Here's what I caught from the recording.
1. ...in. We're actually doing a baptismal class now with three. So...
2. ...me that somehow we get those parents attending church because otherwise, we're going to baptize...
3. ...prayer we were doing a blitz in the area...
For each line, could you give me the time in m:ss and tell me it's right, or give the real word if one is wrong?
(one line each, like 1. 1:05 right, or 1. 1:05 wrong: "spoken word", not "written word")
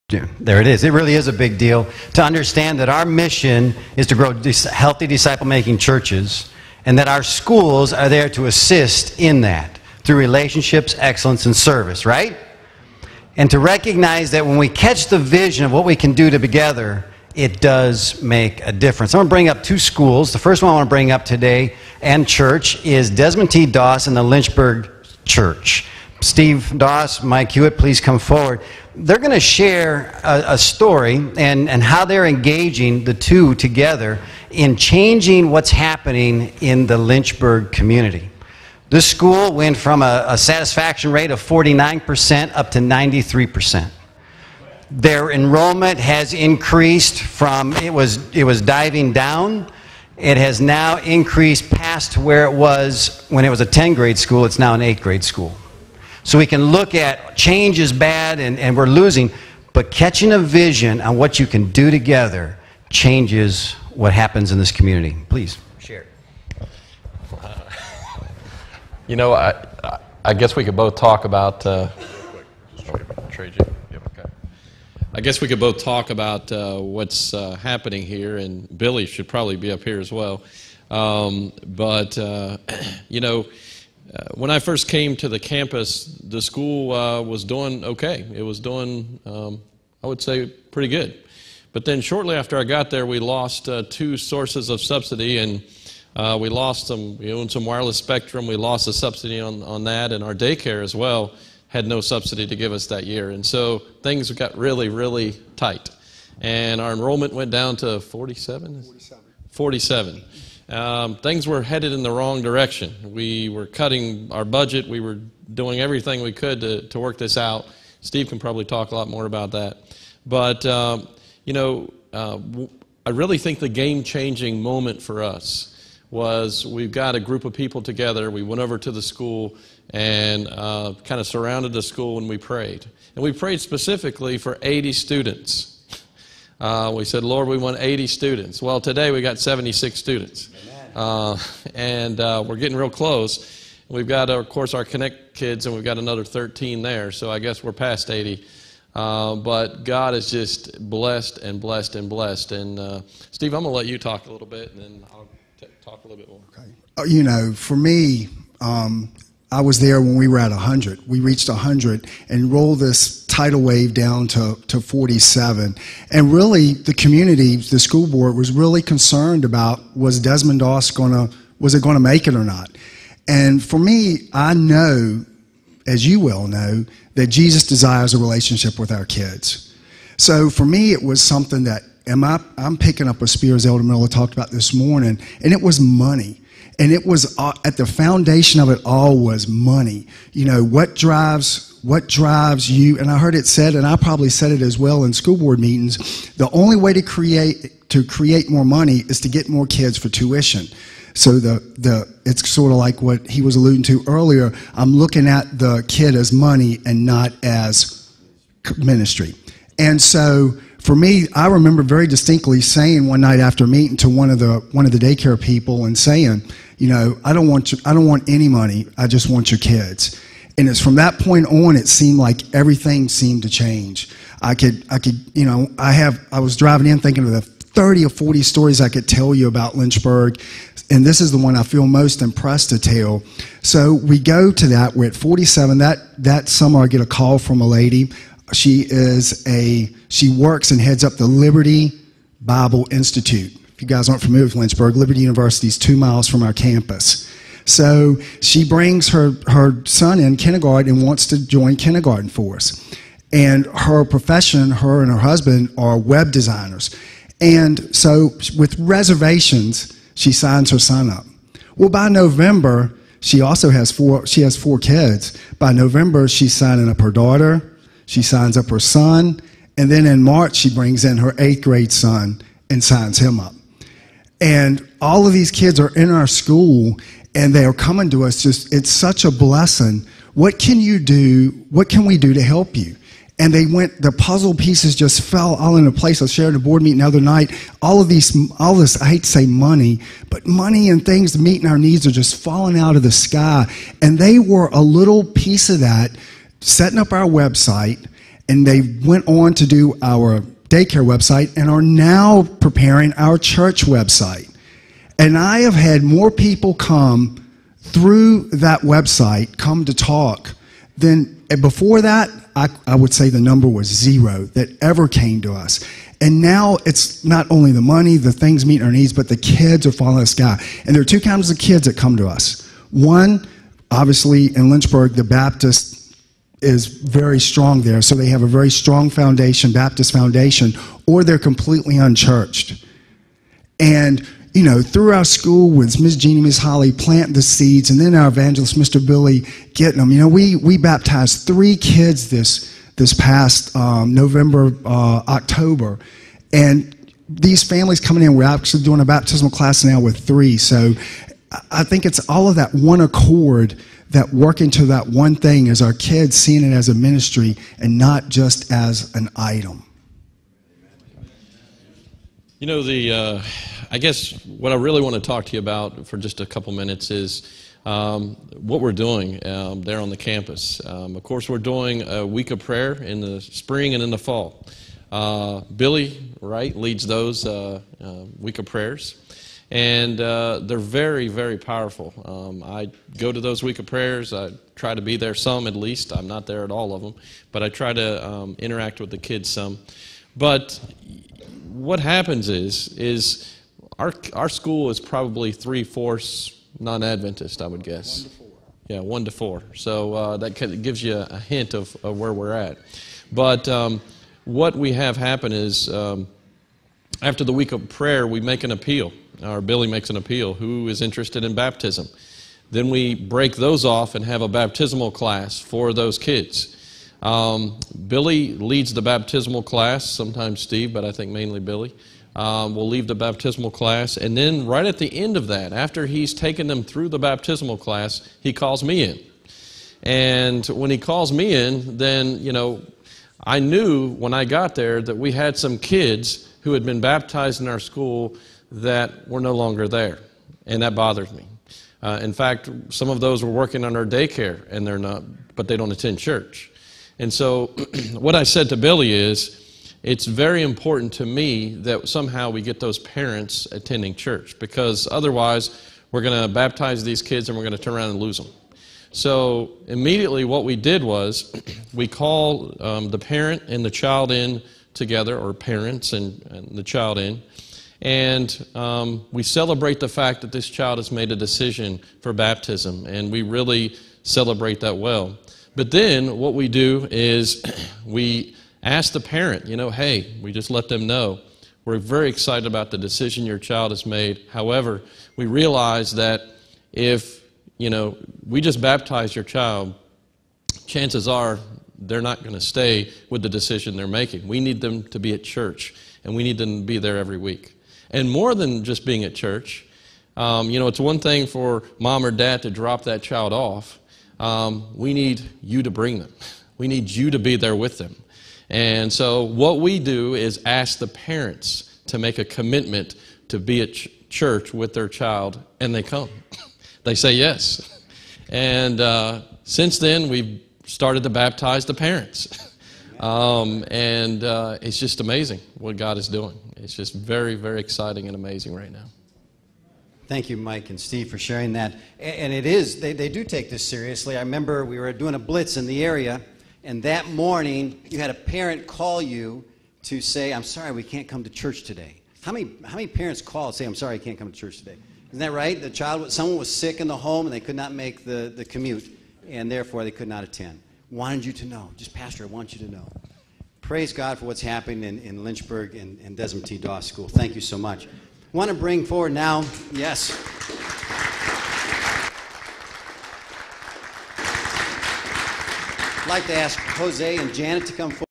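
1. 5:48 right
2. 7:31 right
3. 8:54 wrong: "remember", not "prayer".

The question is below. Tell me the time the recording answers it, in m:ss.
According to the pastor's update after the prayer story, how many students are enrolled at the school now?
2:19.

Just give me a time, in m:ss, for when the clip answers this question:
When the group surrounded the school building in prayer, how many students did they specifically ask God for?
2:13.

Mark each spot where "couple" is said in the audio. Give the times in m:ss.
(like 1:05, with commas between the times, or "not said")
6:06.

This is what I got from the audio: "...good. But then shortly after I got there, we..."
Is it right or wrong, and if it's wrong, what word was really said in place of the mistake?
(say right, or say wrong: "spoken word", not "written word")
right.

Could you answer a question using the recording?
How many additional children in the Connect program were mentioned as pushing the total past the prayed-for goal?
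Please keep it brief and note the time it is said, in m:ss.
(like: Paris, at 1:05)
13, at 2:25.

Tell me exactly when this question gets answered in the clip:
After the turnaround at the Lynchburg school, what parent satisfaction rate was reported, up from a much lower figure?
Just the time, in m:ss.
0:42.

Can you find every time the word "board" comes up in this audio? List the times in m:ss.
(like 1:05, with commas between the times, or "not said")
2:48, 3:15, 4:46.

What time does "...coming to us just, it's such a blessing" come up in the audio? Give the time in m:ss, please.
4:37.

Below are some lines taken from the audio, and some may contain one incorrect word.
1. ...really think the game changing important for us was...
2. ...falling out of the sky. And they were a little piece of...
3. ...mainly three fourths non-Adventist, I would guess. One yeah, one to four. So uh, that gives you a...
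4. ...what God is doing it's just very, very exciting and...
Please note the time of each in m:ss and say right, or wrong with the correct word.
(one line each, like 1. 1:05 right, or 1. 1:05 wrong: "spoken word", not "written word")
1. 2:03 wrong: "moment", not "important"
2. 4:52 right
3. 6:34 wrong: "probably", not "mainly"
4. 8:45 right.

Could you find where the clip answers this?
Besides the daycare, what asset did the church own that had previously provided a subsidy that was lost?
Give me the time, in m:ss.
1:37.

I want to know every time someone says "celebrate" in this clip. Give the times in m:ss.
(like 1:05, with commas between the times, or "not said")
7:49, 7:54.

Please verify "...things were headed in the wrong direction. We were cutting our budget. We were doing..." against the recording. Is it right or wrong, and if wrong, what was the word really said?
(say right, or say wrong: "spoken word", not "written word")
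right.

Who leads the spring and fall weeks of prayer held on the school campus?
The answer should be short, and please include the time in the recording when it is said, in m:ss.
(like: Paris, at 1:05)
Billy Wright, at 6:15.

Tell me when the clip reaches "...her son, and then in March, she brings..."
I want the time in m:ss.
4:28.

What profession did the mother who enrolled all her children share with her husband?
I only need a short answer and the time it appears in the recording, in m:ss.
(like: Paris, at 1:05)
Web designers, at 4:15.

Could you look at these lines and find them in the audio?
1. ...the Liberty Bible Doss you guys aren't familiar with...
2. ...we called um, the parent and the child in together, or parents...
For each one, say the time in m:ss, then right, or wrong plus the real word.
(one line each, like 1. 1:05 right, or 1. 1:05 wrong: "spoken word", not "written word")
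1. 4:01 wrong: "Institute", not "Doss"
2. 7:41 right.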